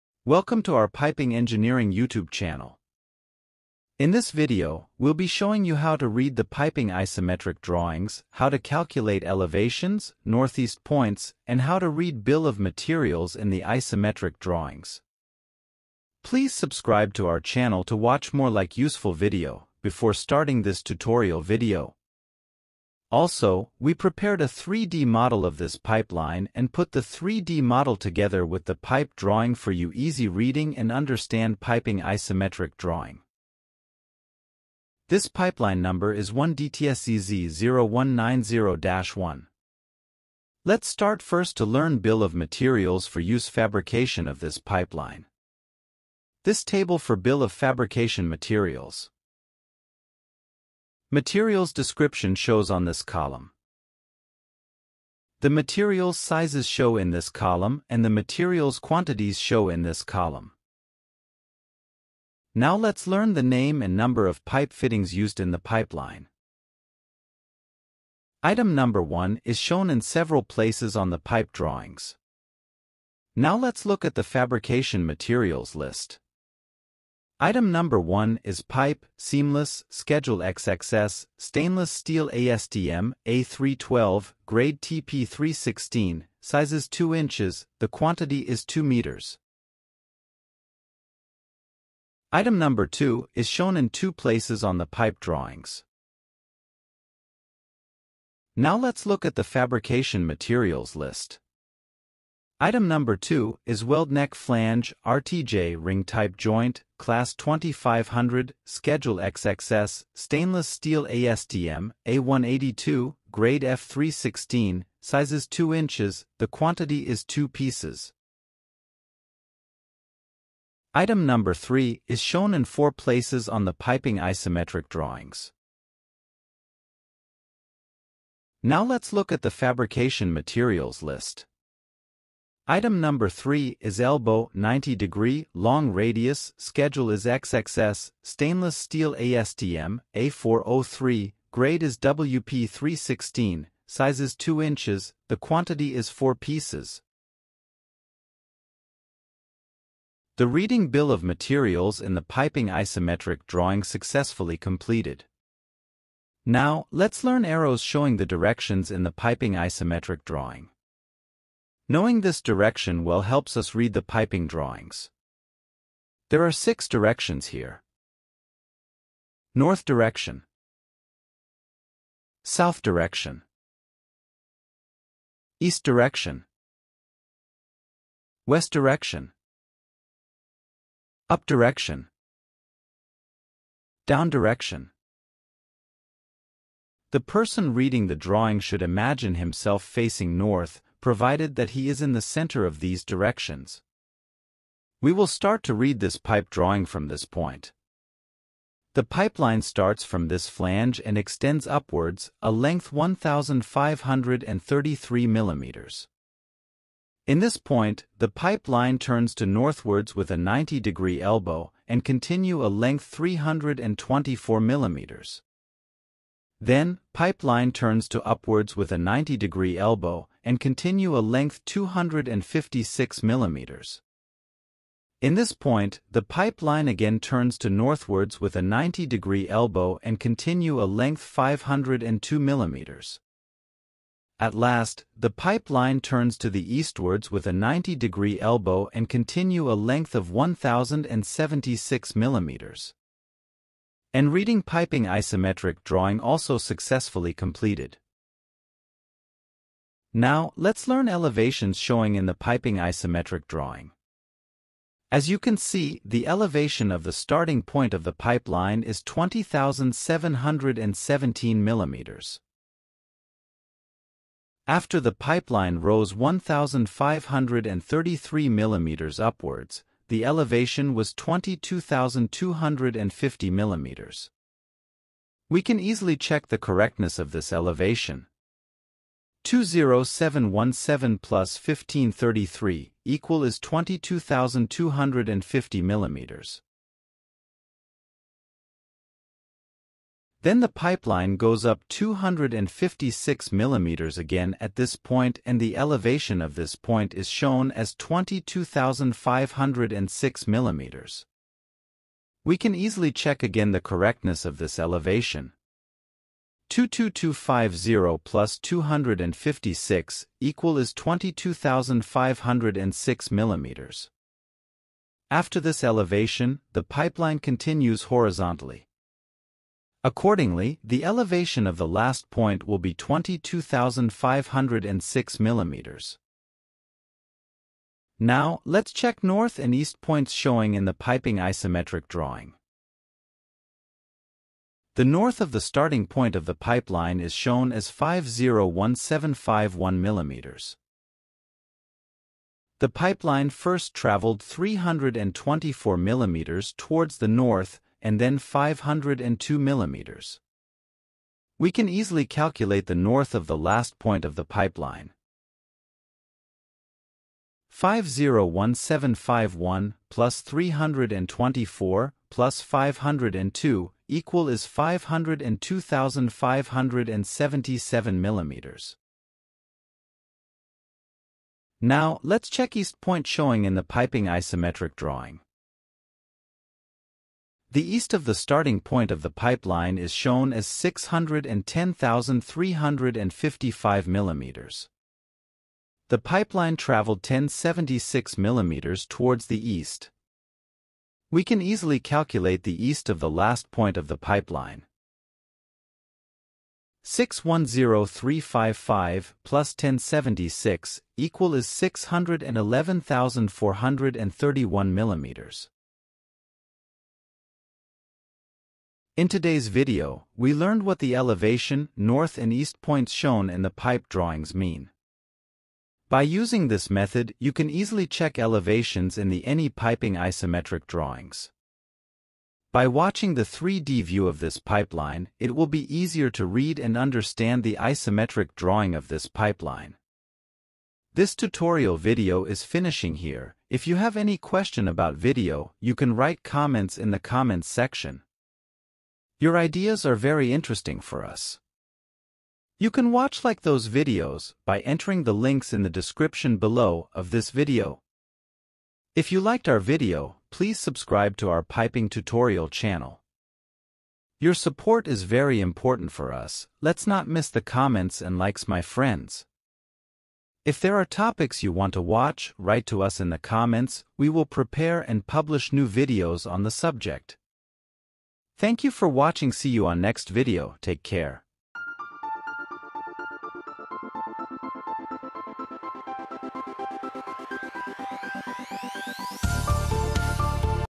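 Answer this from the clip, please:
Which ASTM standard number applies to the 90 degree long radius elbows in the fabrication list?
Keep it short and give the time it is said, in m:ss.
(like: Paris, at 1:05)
A403, at 2:20.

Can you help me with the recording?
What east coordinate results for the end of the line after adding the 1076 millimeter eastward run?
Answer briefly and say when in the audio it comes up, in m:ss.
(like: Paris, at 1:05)
611,431 millimeters, at 6:41.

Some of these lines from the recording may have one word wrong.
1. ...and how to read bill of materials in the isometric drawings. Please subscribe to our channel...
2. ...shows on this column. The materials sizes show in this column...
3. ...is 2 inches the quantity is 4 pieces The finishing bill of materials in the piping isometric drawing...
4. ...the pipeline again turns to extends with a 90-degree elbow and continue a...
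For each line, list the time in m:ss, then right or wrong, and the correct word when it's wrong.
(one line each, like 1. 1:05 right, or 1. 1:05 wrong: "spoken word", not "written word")
1. 0:11 right
2. 0:52 right
3. 2:24 wrong: "reading", not "finishing"
4. 3:46 wrong: "northwards", not "extends".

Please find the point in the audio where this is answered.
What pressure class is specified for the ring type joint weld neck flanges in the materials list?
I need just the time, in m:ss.
1:46.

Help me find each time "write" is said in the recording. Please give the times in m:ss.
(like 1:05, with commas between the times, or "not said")
7:16, 7:42.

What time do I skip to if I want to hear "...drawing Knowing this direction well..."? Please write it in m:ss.
2:40.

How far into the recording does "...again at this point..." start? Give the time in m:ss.
4:54.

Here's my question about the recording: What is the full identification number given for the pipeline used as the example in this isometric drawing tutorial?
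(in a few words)
1DTSCZ0190-1.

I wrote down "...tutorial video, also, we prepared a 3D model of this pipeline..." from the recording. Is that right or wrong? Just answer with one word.
right.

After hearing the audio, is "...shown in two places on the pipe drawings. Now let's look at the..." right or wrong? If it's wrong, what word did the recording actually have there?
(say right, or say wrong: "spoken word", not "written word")
right.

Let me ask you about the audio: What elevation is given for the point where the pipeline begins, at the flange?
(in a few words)
20,717 millimeters.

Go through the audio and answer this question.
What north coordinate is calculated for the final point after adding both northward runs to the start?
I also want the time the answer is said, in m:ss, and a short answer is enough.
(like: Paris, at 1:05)
502,577 millimeters, at 6:04.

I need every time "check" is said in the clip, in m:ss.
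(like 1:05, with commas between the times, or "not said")
5:03, 5:28, 6:12, 6:58.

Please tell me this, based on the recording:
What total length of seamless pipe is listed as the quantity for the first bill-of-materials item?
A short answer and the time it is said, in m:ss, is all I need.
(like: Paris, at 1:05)
2 meters, at 1:28.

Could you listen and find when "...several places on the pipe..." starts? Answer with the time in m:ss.
1:09.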